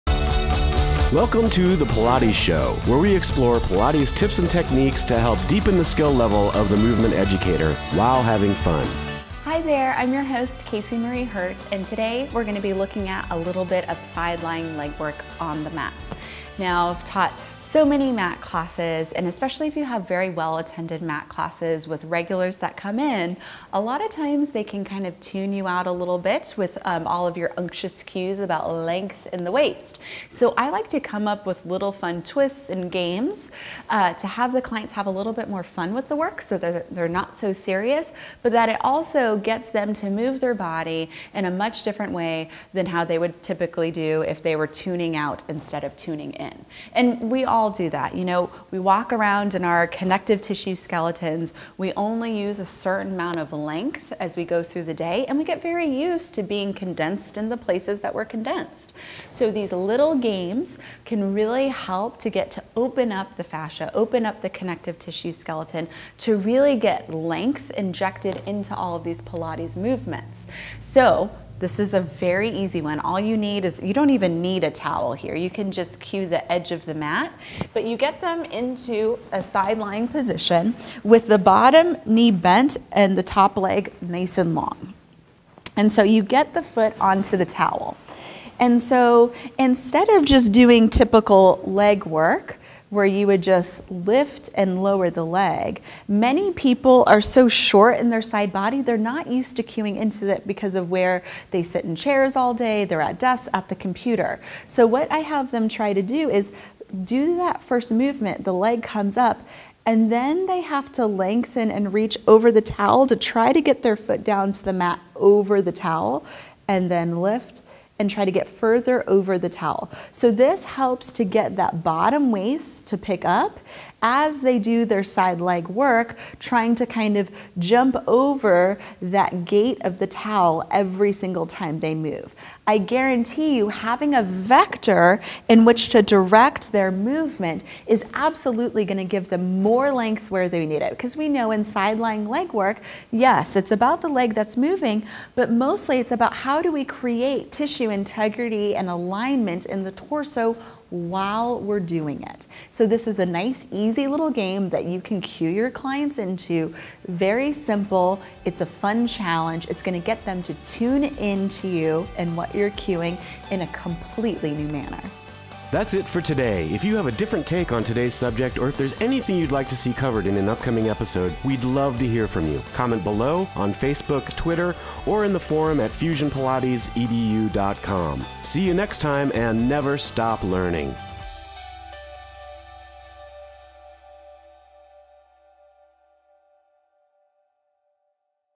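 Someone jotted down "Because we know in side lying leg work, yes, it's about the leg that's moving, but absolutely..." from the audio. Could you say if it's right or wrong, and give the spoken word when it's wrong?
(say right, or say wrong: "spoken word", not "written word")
wrong: "mostly", not "absolutely".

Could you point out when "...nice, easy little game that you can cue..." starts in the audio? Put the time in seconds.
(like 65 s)
153 s.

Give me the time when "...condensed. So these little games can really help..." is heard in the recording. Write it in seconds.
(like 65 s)
58 s.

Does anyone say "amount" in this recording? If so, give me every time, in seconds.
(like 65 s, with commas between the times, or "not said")
53 s.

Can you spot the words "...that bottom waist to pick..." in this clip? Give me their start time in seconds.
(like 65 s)
121 s.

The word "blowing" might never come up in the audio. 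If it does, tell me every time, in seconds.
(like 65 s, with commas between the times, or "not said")
not said.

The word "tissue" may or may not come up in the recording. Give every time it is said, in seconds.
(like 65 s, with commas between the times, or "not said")
50 s, 64 s, 147 s.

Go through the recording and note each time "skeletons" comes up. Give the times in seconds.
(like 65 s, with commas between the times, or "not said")
50 s, 65 s.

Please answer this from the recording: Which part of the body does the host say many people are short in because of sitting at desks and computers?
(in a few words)
Side body.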